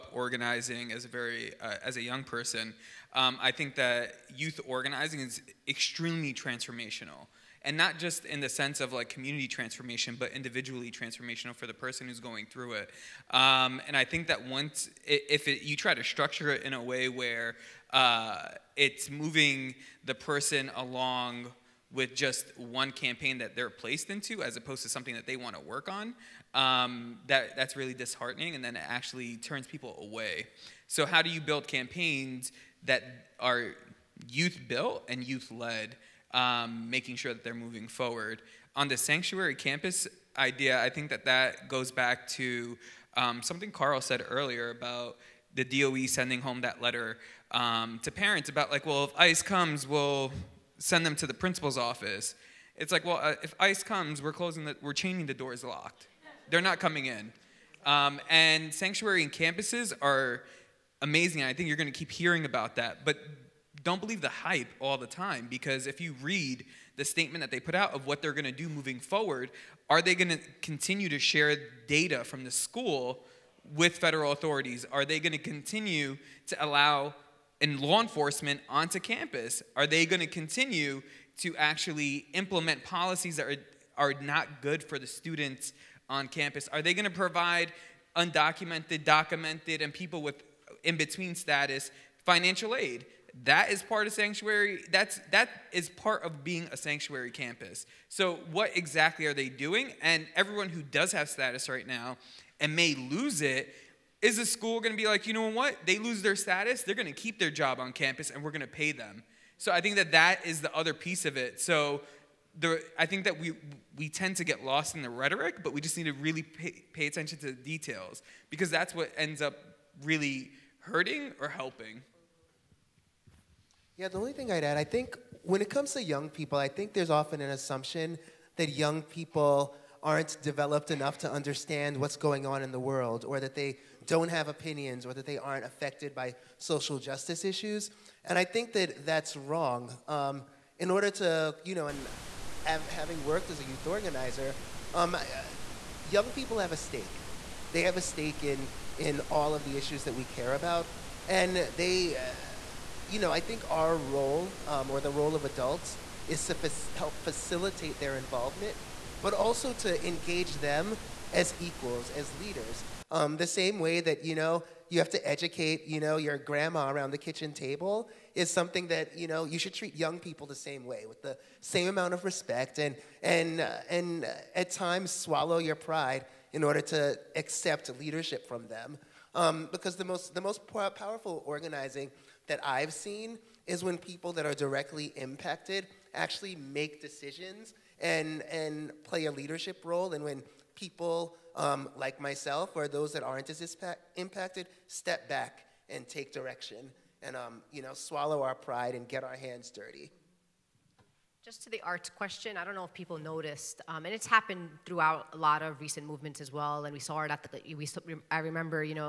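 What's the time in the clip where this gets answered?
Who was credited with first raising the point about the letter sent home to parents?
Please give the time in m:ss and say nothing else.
0:43.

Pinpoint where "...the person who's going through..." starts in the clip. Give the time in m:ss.
0:11.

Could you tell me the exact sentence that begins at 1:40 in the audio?
And everyone who does have status right now and may lose it, is the school going to be like, you know what?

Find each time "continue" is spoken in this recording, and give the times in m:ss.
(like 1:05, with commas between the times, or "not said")
1:10, 1:15, 1:20.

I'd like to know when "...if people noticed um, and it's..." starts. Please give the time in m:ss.
3:22.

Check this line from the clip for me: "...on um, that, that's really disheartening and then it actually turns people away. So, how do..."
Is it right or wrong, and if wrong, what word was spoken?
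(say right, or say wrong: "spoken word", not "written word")
right.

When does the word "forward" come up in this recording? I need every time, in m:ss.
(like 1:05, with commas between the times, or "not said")
0:37, 1:08.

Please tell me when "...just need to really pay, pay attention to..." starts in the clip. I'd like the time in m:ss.
1:55.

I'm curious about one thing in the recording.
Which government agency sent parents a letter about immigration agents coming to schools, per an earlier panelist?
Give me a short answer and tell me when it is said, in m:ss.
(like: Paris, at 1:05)
DOE, at 0:45.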